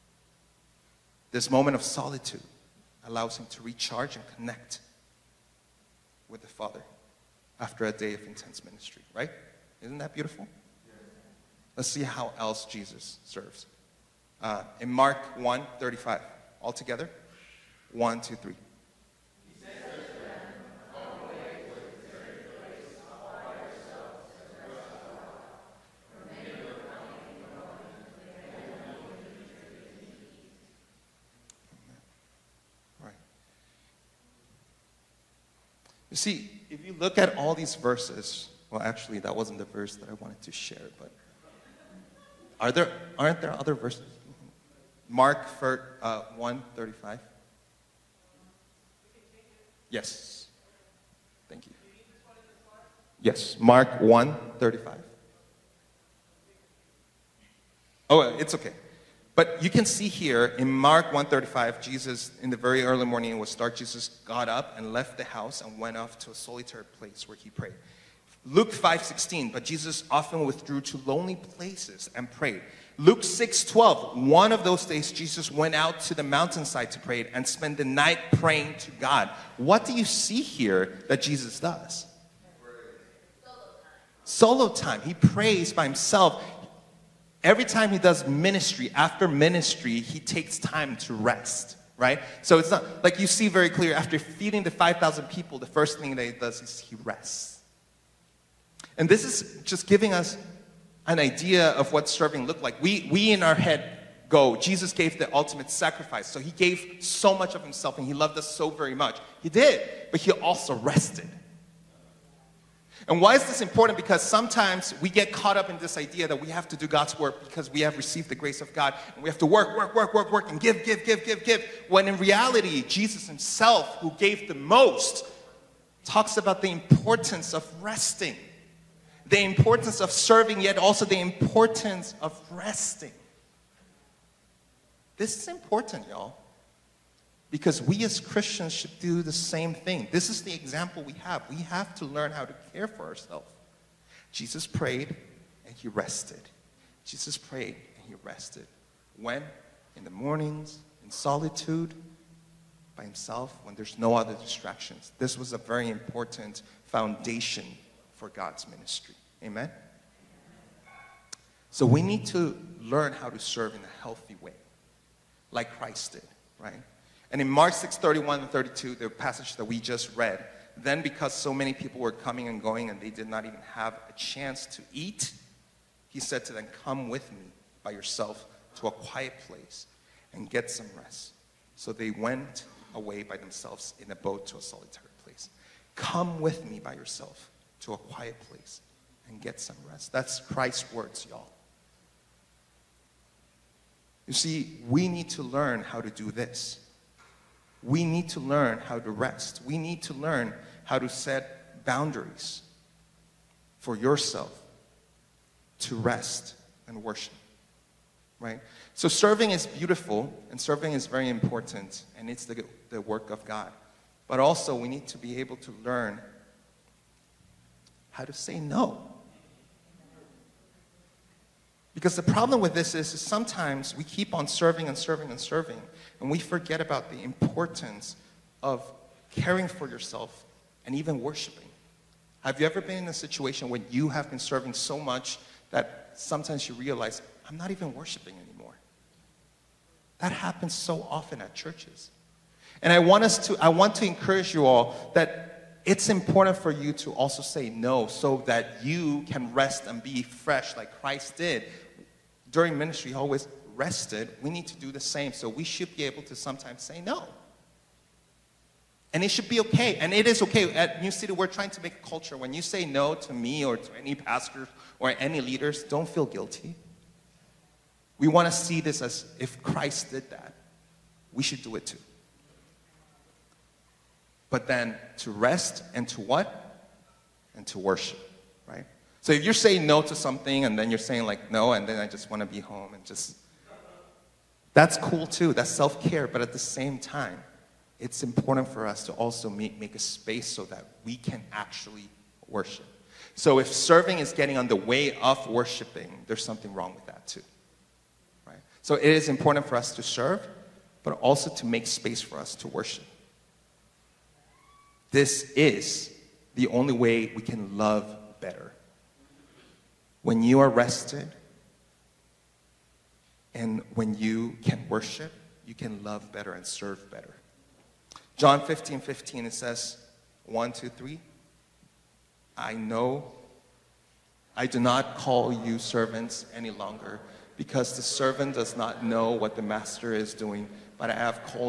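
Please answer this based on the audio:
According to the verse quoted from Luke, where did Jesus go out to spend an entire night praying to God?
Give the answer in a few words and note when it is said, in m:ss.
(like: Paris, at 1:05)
the mountainside, at 1:16.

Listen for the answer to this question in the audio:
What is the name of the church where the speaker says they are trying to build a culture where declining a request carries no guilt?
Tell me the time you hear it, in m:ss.
4:21.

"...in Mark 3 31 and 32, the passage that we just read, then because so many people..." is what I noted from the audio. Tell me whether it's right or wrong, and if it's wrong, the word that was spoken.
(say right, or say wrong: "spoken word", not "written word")
wrong: "6", not "3".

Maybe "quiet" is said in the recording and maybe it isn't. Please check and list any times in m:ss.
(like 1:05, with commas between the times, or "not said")
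2:58, 3:07.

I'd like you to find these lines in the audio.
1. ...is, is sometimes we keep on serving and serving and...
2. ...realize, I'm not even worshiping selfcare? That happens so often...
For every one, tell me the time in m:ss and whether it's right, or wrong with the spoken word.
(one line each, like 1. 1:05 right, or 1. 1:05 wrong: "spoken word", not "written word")
1. 3:42 right
2. 3:56 wrong: "anymore", not "selfcare".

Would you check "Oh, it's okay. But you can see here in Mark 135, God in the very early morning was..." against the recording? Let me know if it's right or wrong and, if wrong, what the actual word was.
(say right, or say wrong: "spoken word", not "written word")
wrong: "Jesus", not "God".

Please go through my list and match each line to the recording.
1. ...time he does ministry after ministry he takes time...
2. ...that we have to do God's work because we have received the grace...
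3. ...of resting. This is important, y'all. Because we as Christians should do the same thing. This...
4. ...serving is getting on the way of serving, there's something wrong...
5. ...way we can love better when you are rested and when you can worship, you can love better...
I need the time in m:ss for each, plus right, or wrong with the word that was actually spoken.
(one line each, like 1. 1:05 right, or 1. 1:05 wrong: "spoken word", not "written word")
1. 1:27 right
2. 1:56 right
3. 2:12 right
4. 4:53 wrong: "worshiping", not "serving"
5. 5:06 right.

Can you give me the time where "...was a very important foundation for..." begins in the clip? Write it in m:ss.
2:35.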